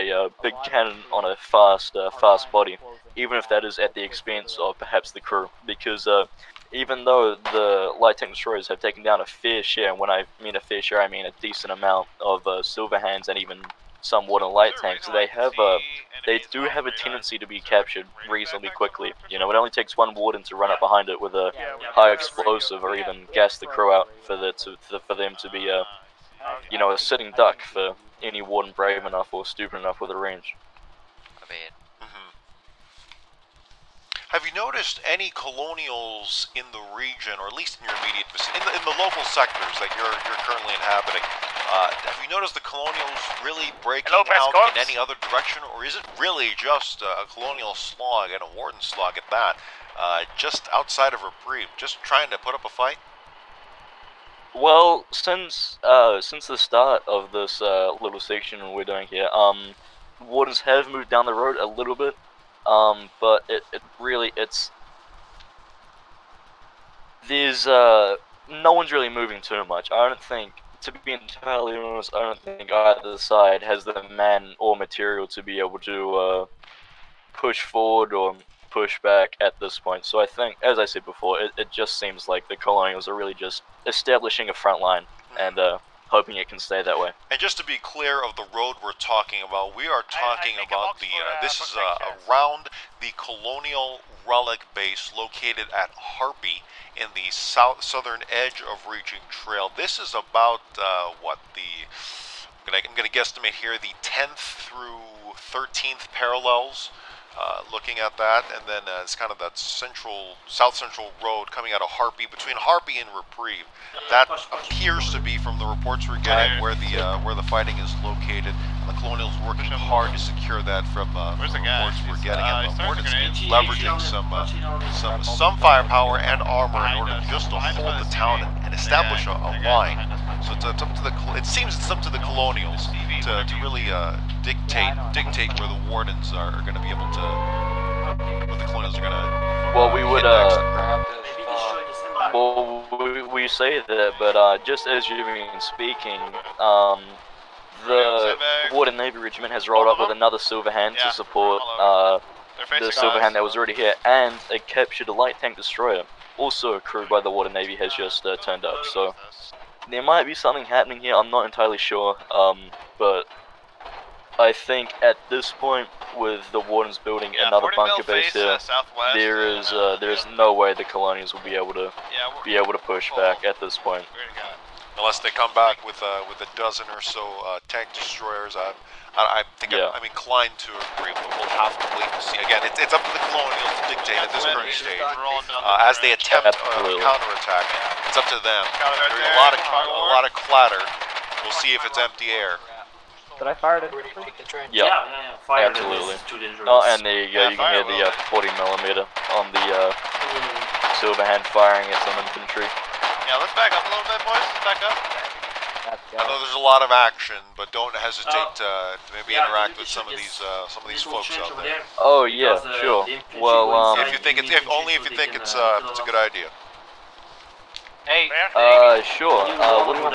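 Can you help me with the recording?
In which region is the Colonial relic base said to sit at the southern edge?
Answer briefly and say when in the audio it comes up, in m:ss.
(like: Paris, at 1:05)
Reaching Trail, at 1:38.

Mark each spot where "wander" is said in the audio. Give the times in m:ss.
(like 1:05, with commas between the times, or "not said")
not said.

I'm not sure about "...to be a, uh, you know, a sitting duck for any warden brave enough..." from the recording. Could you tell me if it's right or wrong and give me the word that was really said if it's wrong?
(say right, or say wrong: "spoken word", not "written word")
right.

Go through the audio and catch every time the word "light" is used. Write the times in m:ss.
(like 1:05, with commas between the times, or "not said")
0:07, 0:14, 2:35.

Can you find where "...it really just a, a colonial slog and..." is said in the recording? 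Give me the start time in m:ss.
0:45.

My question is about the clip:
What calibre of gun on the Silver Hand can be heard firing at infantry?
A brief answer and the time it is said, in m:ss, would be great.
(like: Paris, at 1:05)
40 millimeter, at 3:18.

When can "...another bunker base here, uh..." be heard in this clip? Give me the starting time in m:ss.
2:47.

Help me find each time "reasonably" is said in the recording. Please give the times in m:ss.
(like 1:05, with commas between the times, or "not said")
0:18.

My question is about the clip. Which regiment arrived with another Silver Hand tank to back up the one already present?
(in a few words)
Water Navy Regiment.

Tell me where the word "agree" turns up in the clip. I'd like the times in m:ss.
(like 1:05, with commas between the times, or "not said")
3:00.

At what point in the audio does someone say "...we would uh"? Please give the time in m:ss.
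2:19.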